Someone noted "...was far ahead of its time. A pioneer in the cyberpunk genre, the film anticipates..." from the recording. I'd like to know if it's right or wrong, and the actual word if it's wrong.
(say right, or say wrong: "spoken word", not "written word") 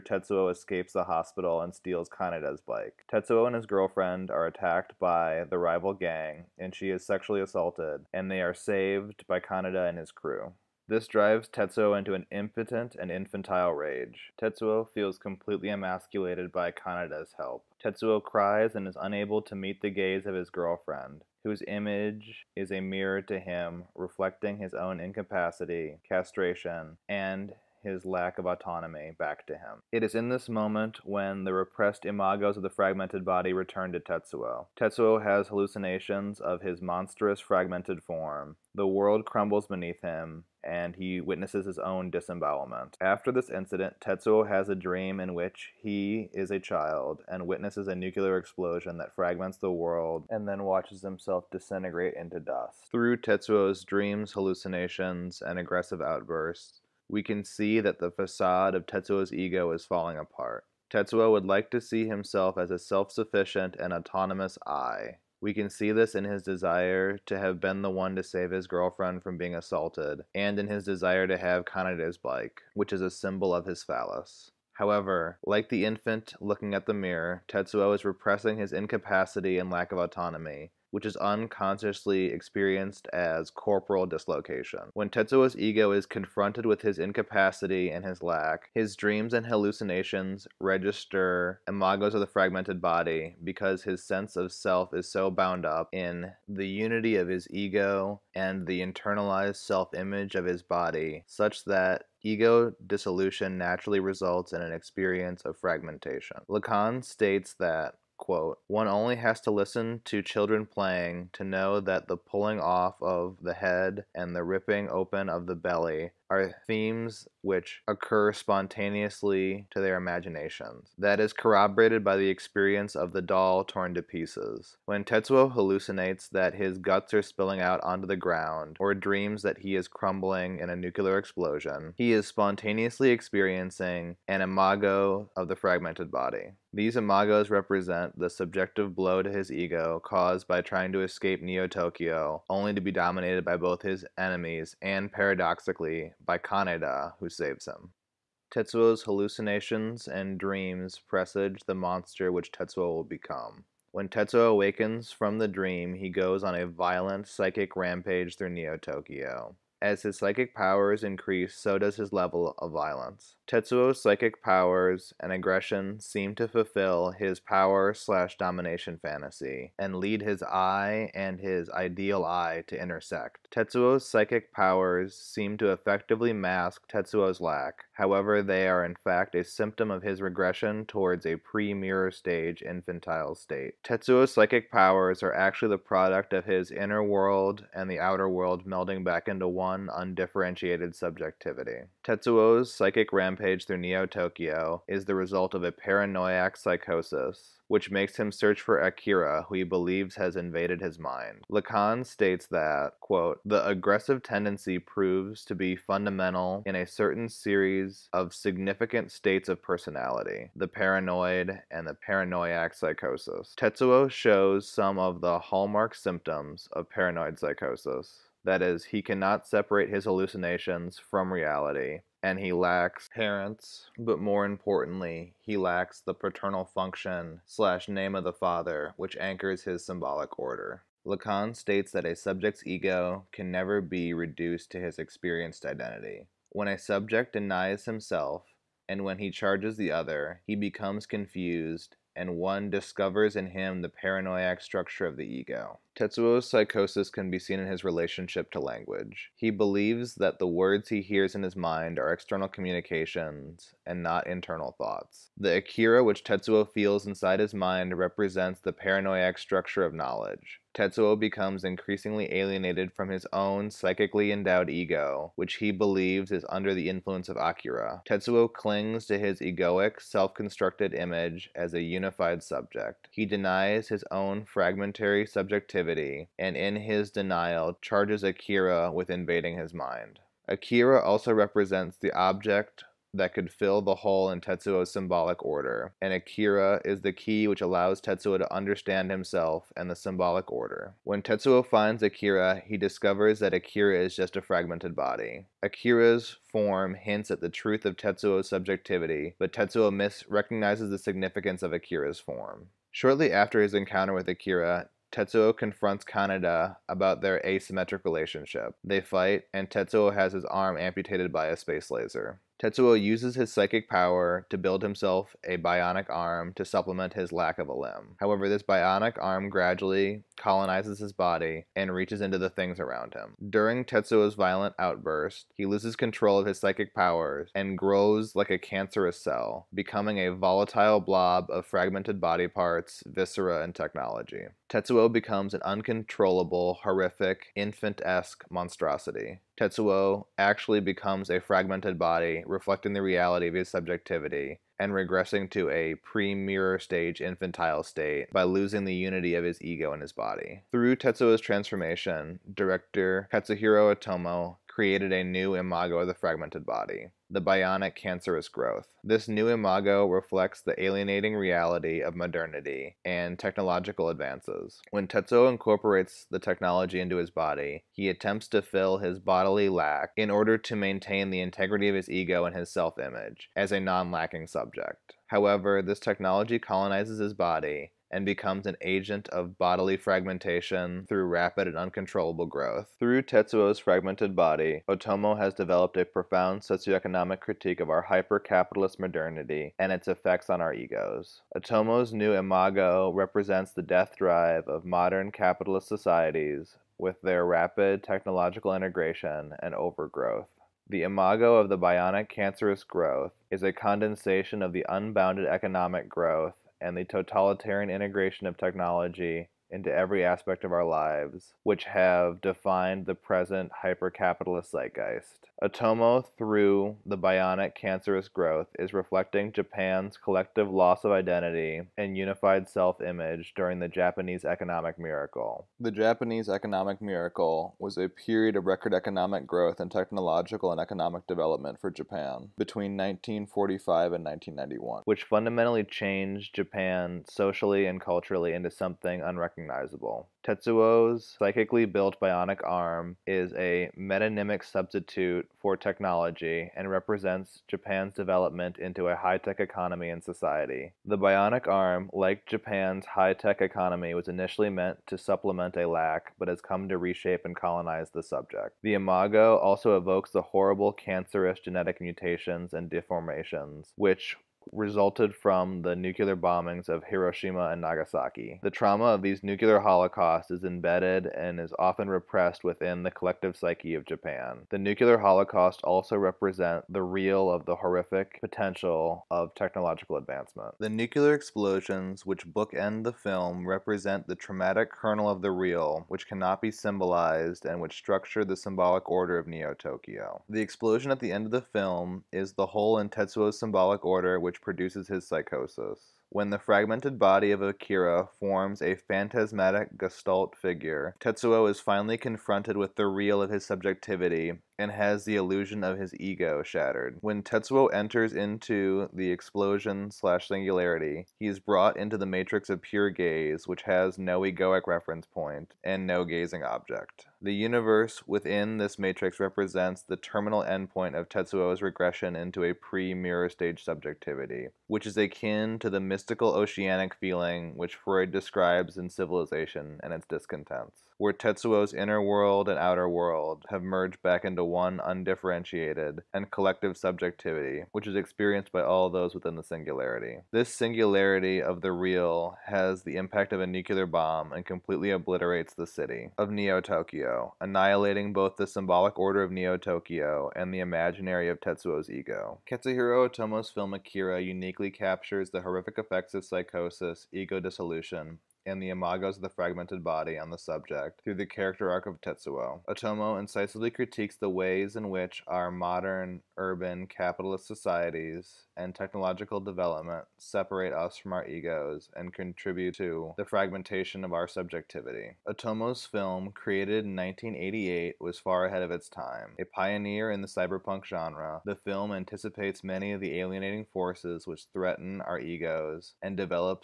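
right.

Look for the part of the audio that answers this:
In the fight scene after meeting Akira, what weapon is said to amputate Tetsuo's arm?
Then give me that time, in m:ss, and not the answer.
5:11.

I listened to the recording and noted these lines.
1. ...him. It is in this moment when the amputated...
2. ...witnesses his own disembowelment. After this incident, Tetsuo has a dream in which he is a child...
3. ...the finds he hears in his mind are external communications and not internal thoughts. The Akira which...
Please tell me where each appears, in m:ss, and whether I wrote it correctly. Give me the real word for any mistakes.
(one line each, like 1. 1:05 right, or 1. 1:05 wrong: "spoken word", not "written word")
1. 0:29 wrong: "repressed", not "amputated"
2. 0:41 right
3. 4:10 wrong: "words", not "finds".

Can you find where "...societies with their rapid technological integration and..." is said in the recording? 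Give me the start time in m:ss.
6:35.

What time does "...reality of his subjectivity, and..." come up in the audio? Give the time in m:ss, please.
5:43.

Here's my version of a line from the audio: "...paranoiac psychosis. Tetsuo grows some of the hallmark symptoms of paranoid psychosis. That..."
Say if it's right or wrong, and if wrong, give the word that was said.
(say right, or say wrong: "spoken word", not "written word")
wrong: "shows", not "grows".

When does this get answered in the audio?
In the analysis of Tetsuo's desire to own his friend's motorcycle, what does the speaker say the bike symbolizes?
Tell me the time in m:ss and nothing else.
1:13.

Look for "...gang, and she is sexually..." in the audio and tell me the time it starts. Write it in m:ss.
0:05.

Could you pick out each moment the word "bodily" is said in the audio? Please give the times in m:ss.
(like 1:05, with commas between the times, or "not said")
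6:09, 6:19.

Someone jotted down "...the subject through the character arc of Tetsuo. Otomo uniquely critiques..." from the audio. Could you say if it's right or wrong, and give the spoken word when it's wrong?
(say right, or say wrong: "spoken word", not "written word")
wrong: "incisively", not "uniquely".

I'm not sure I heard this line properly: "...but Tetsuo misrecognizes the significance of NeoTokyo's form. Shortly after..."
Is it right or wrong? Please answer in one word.
wrong.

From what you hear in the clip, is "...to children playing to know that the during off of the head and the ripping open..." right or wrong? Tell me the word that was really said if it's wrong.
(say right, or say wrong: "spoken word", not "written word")
wrong: "pulling", not "during".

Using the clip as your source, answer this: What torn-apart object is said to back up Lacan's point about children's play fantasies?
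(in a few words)
The doll.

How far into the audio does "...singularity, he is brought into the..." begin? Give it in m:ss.
8:30.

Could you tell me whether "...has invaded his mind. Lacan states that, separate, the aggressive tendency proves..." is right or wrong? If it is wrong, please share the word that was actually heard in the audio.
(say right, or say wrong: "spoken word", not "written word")
wrong: "quote", not "separate".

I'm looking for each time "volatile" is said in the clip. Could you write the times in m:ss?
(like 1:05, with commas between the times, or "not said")
5:30.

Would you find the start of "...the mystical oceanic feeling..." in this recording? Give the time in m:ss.
8:45.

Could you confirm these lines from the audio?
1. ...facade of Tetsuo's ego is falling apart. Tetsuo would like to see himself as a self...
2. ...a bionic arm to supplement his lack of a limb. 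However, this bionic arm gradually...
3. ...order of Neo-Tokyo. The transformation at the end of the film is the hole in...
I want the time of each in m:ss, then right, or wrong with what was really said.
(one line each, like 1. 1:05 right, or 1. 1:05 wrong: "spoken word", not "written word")
1. 0:58 right
2. 5:15 right
3. 8:09 wrong: "explosion", not "transformation".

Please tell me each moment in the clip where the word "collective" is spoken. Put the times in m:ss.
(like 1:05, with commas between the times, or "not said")
7:00, 7:53, 8:56.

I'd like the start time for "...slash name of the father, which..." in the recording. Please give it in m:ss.
3:47.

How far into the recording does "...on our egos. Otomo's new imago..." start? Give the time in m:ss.
6:30.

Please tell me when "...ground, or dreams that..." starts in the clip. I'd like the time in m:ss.
2:08.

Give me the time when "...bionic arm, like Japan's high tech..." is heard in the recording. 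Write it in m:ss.
7:31.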